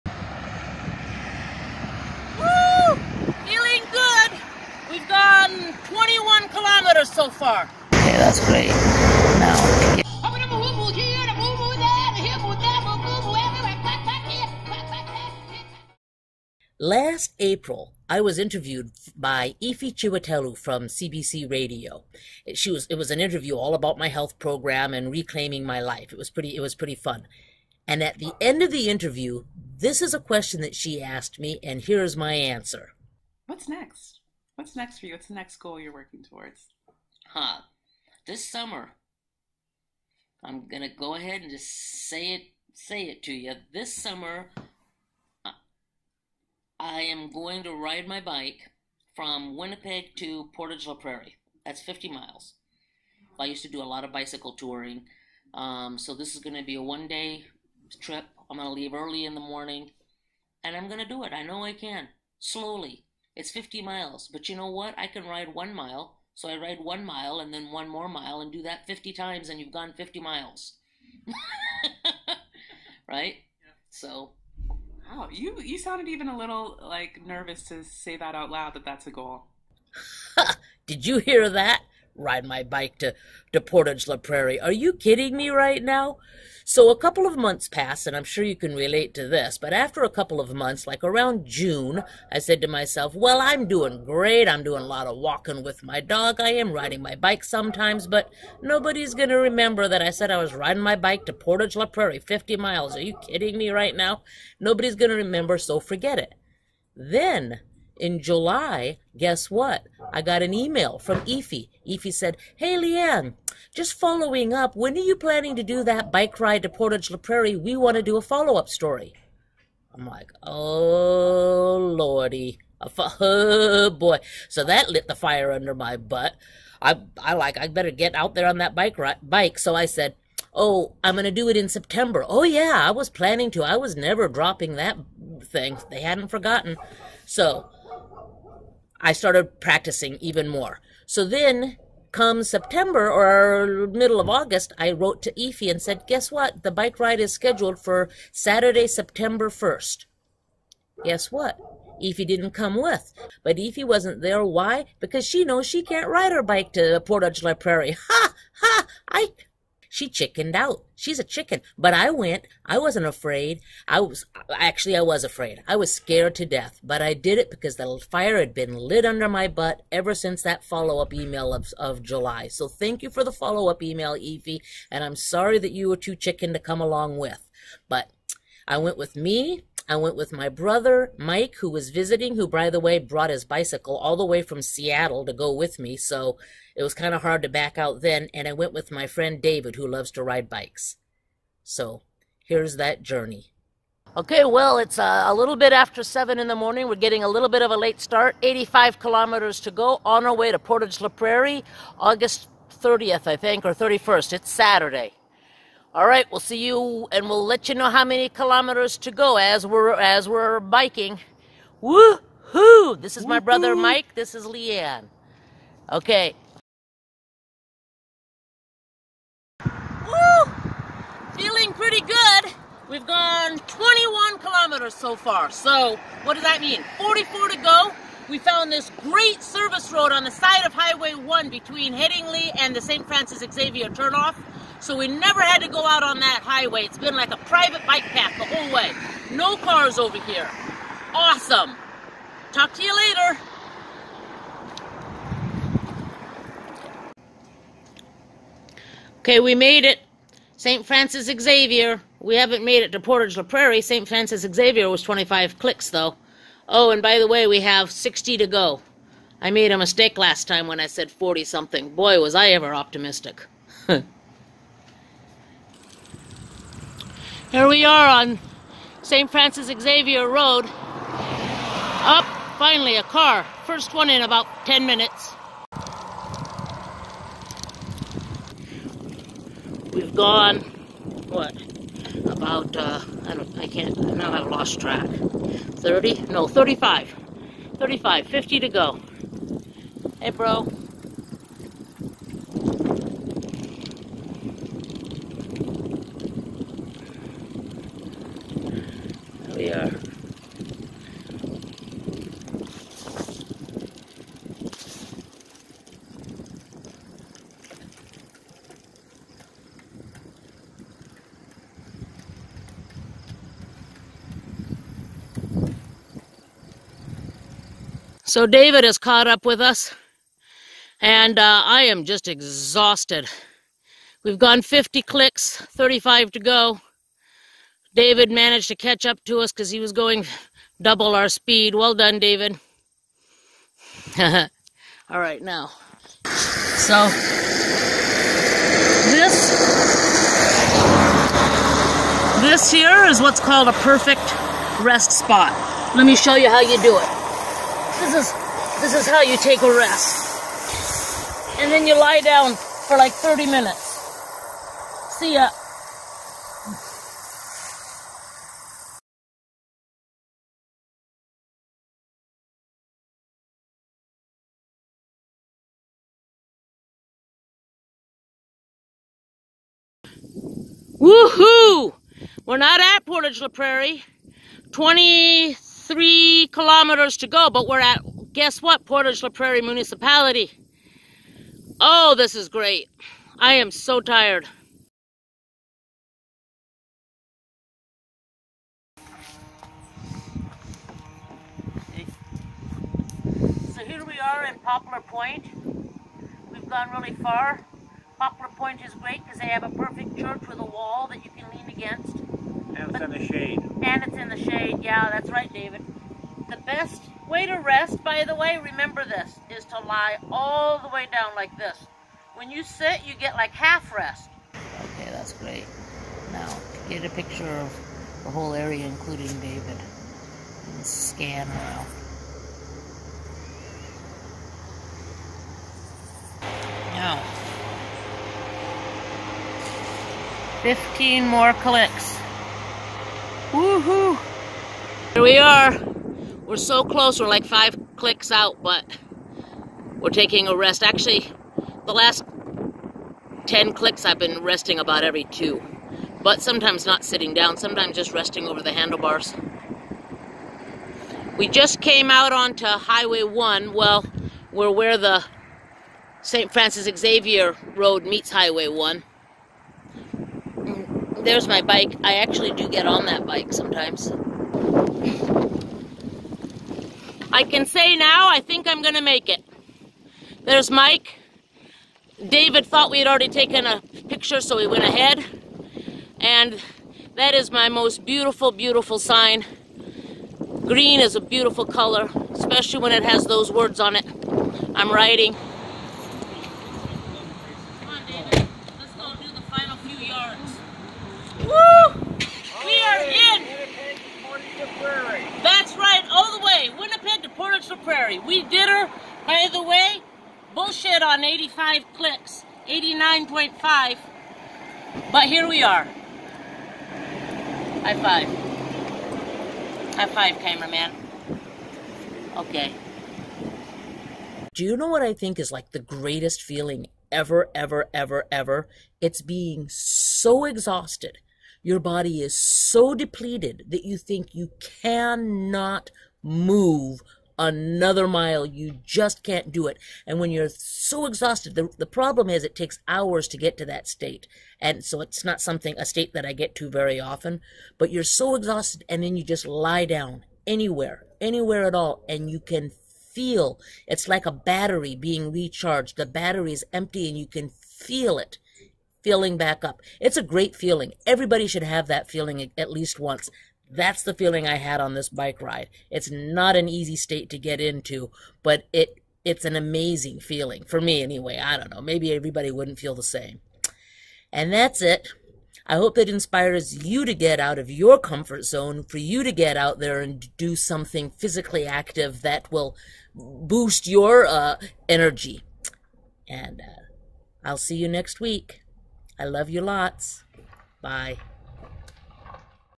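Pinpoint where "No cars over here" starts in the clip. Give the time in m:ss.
3:59.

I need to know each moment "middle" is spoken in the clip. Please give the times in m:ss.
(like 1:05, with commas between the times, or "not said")
2:23.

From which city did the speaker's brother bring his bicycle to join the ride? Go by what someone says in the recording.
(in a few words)
Seattle.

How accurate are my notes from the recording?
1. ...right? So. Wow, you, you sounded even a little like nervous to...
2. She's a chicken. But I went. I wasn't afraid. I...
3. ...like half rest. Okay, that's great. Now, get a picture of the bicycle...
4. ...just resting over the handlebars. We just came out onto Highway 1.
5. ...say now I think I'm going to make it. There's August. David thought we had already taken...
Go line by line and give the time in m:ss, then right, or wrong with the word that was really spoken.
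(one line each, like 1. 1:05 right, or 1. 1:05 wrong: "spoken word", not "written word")
1. 1:13 right
2. 2:40 right
3. 6:53 wrong: "whole", not "bicycle"
4. 7:27 right
5. 7:47 wrong: "Mike", not "August".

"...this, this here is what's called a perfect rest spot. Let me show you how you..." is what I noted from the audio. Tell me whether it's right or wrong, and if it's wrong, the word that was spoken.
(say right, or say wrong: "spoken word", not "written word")
right.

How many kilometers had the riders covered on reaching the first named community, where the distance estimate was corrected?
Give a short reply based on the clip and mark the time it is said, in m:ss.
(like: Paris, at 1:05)
25, at 4:15.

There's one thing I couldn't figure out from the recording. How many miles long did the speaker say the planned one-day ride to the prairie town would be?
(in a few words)
50 miles.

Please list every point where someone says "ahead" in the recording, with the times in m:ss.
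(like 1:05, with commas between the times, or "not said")
0:41, 7:54.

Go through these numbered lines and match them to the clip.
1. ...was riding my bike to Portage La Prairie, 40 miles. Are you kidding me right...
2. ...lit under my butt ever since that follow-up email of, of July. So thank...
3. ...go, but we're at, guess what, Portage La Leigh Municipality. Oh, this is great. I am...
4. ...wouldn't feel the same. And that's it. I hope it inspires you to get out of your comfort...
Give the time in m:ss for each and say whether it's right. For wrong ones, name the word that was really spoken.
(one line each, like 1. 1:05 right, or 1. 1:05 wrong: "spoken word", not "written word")
1. 1:40 wrong: "50", not "40"
2. 2:48 right
3. 6:17 wrong: "Prairie", not "Leigh"
4. 9:22 right.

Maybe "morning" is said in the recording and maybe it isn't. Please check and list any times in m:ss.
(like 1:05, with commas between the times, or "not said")
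0:59, 3:16.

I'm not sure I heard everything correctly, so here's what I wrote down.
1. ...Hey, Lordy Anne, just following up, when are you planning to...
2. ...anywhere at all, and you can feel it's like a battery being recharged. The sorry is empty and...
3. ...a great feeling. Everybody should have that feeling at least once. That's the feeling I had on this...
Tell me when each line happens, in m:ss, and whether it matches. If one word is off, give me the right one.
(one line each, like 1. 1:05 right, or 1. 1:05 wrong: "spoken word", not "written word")
1. 1:52 wrong: "Leigh", not "Lordy"
2. 9:01 wrong: "battery", not "sorry"
3. 9:10 right.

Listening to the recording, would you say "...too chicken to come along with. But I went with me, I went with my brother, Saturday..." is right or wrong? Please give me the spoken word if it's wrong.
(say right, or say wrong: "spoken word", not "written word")
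wrong: "Mike", not "Saturday".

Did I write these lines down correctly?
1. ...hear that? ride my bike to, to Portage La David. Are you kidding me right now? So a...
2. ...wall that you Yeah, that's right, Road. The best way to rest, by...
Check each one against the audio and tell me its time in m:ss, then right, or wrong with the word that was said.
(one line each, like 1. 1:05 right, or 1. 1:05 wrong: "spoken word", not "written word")
1. 1:21 wrong: "Prairie", not "David"
2. 6:40 wrong: "David", not "Road".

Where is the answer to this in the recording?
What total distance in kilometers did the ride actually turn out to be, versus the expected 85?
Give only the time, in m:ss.
8:22.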